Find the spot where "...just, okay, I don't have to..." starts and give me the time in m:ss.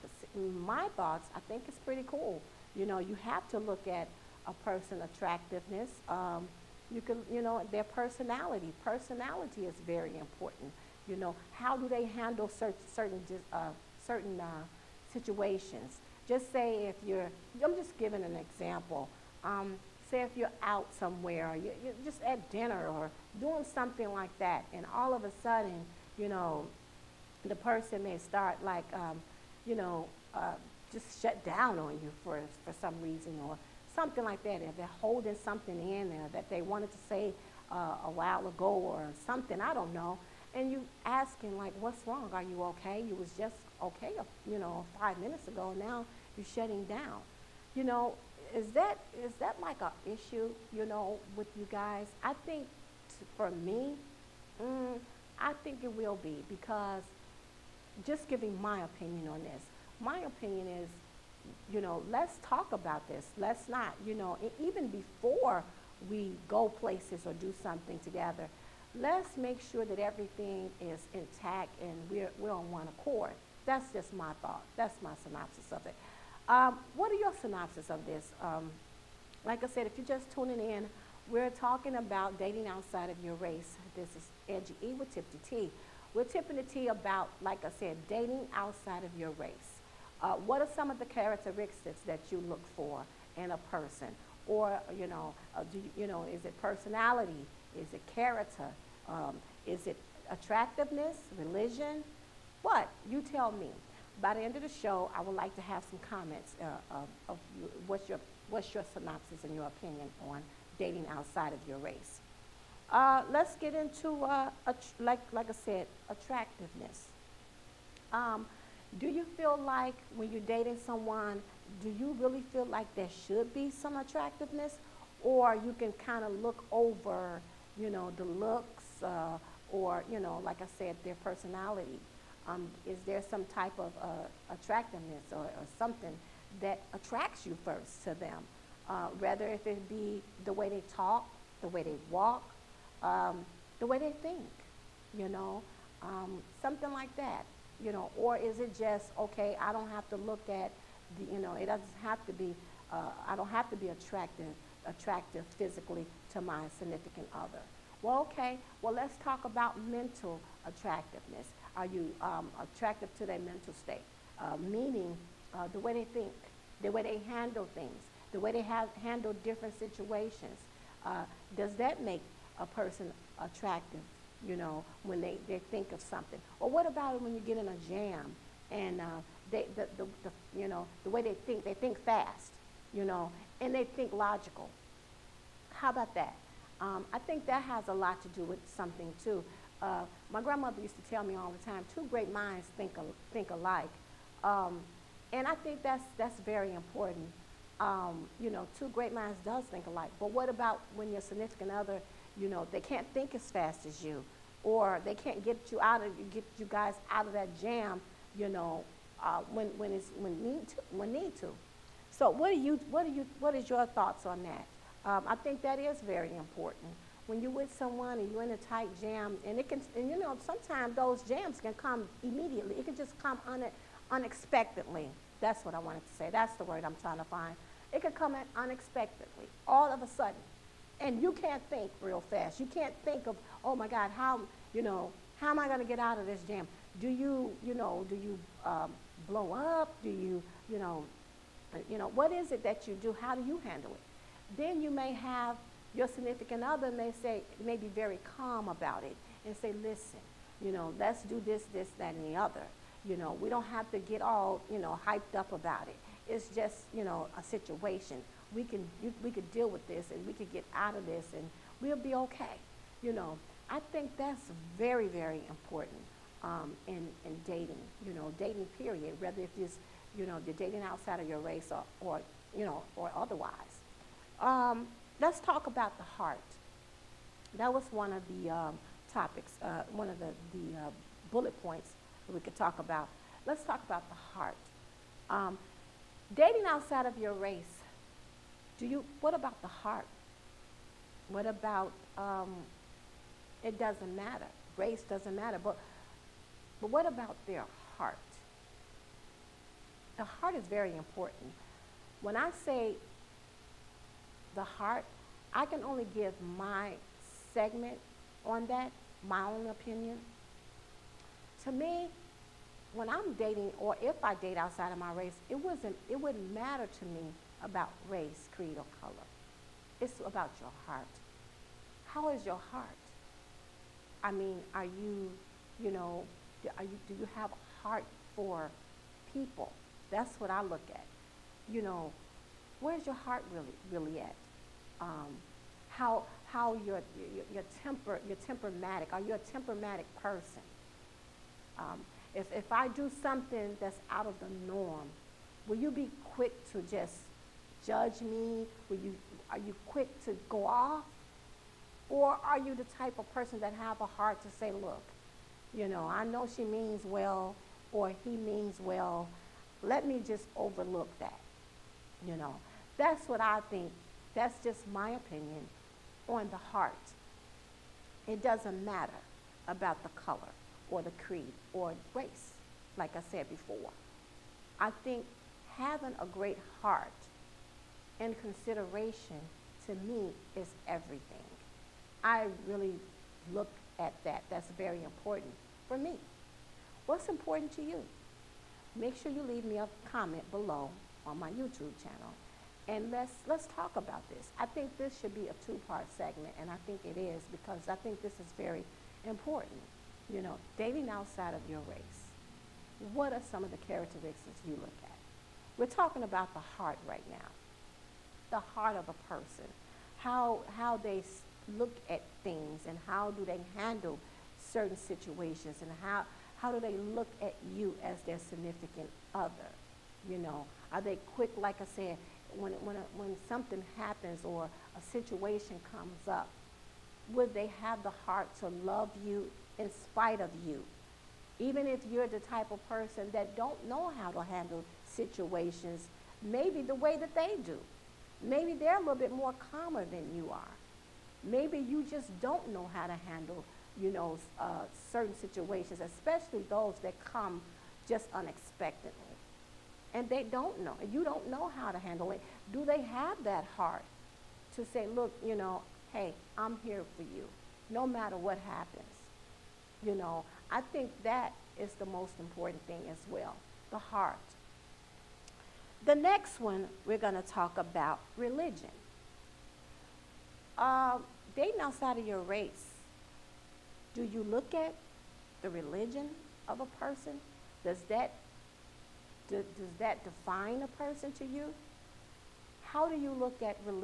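2:28.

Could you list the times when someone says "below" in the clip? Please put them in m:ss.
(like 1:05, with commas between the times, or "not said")
6:30.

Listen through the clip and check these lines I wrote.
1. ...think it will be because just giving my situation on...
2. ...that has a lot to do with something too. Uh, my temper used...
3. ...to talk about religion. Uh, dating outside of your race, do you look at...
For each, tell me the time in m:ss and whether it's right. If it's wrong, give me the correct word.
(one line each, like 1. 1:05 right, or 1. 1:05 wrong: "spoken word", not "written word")
1. 0:55 wrong: "opinion", not "situation"
2. 3:07 wrong: "grandmother", not "temper"
3. 7:47 right.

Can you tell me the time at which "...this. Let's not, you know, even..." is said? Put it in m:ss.
1:03.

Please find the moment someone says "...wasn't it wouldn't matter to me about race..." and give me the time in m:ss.
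5:15.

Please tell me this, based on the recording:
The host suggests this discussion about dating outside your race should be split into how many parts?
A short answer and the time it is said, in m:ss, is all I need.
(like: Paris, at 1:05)
2, at 6:35.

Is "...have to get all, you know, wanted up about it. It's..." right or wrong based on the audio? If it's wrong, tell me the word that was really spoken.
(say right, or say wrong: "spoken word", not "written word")
wrong: "hyped", not "wanted".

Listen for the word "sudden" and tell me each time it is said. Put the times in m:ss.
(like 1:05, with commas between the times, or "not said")
0:25, 3:50.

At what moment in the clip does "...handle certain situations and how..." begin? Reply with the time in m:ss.
6:53.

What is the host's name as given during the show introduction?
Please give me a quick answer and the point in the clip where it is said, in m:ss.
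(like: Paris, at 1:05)
Angie E, at 1:24.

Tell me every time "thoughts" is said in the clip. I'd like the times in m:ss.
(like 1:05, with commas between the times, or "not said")
0:00, 1:14, 3:33.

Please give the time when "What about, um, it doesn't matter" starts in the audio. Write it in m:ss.
4:51.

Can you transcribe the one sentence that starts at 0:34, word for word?
If they're holding something in there that they wanted to say uh, a while ago or something, I don't know.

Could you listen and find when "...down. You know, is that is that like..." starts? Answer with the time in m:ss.
0:46.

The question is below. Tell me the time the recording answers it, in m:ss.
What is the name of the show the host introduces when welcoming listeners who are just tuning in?
1:25.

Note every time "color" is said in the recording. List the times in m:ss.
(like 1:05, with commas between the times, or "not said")
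5:19, 6:10.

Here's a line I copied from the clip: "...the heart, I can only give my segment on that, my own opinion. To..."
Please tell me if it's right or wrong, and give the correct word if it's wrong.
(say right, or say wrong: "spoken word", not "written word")
right.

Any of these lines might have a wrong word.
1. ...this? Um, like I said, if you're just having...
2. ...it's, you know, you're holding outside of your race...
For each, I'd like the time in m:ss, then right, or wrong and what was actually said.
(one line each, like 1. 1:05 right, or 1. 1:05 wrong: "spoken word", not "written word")
1. 1:18 wrong: "tuning", not "having"
2. 4:29 wrong: "dating", not "holding".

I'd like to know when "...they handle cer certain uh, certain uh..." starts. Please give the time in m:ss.
0:11.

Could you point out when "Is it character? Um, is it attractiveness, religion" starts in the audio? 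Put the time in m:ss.
1:37.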